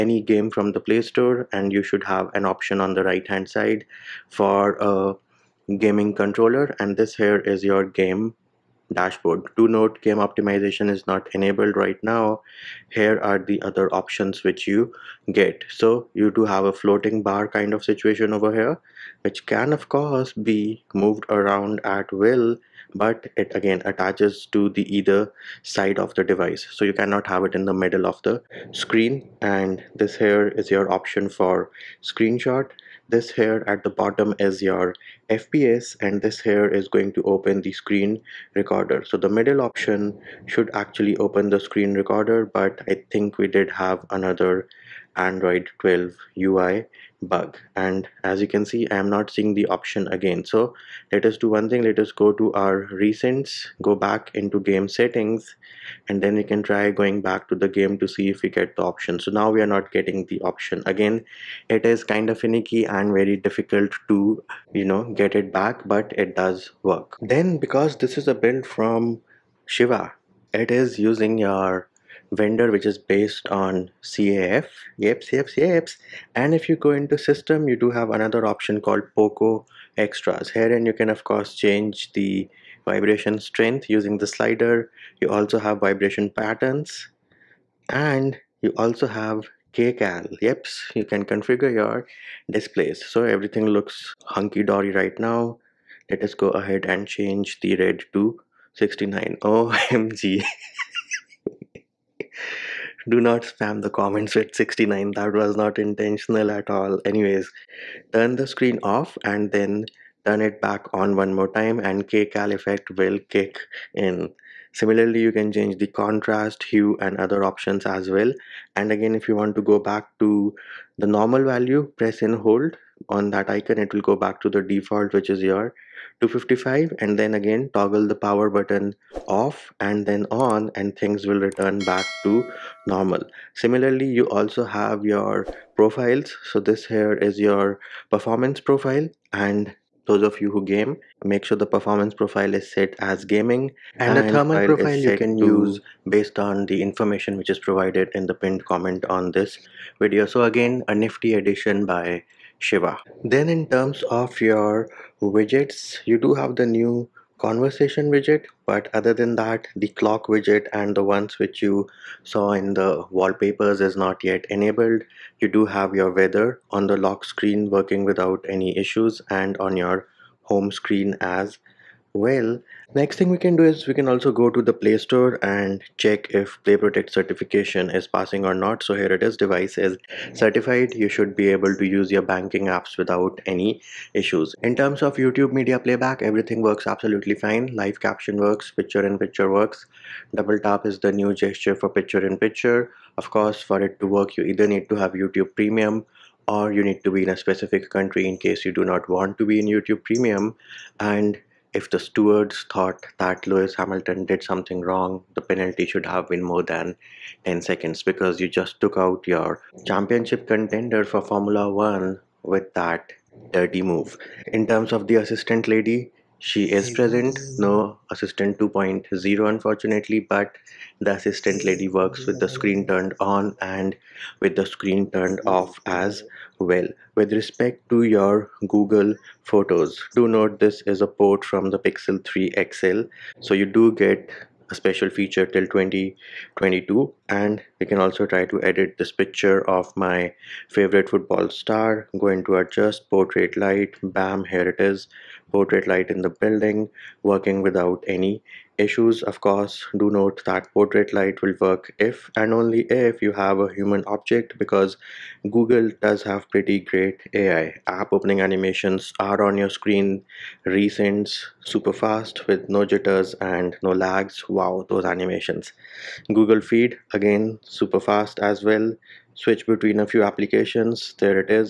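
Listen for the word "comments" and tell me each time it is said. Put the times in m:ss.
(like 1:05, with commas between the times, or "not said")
1:43, 2:28.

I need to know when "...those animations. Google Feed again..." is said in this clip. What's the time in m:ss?
4:24.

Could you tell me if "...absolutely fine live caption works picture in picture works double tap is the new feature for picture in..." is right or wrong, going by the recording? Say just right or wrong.
wrong.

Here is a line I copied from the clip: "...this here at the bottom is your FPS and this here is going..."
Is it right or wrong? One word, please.
right.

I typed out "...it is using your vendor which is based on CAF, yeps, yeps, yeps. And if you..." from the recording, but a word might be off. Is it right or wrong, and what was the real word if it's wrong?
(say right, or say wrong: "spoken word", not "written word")
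right.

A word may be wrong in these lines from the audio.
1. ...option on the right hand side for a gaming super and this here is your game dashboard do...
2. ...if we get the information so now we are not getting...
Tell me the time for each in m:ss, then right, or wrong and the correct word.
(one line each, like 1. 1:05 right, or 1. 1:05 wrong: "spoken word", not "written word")
1. 0:02 wrong: "controller", not "super"
2. 0:58 wrong: "option", not "information".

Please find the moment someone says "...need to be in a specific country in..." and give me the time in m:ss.
3:16.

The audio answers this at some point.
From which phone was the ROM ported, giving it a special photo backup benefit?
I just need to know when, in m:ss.
3:51.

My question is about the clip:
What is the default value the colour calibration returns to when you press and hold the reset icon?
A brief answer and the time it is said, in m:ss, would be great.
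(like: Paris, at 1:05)
255, at 2:06.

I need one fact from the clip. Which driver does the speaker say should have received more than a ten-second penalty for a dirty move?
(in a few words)
Lewis Hamilton.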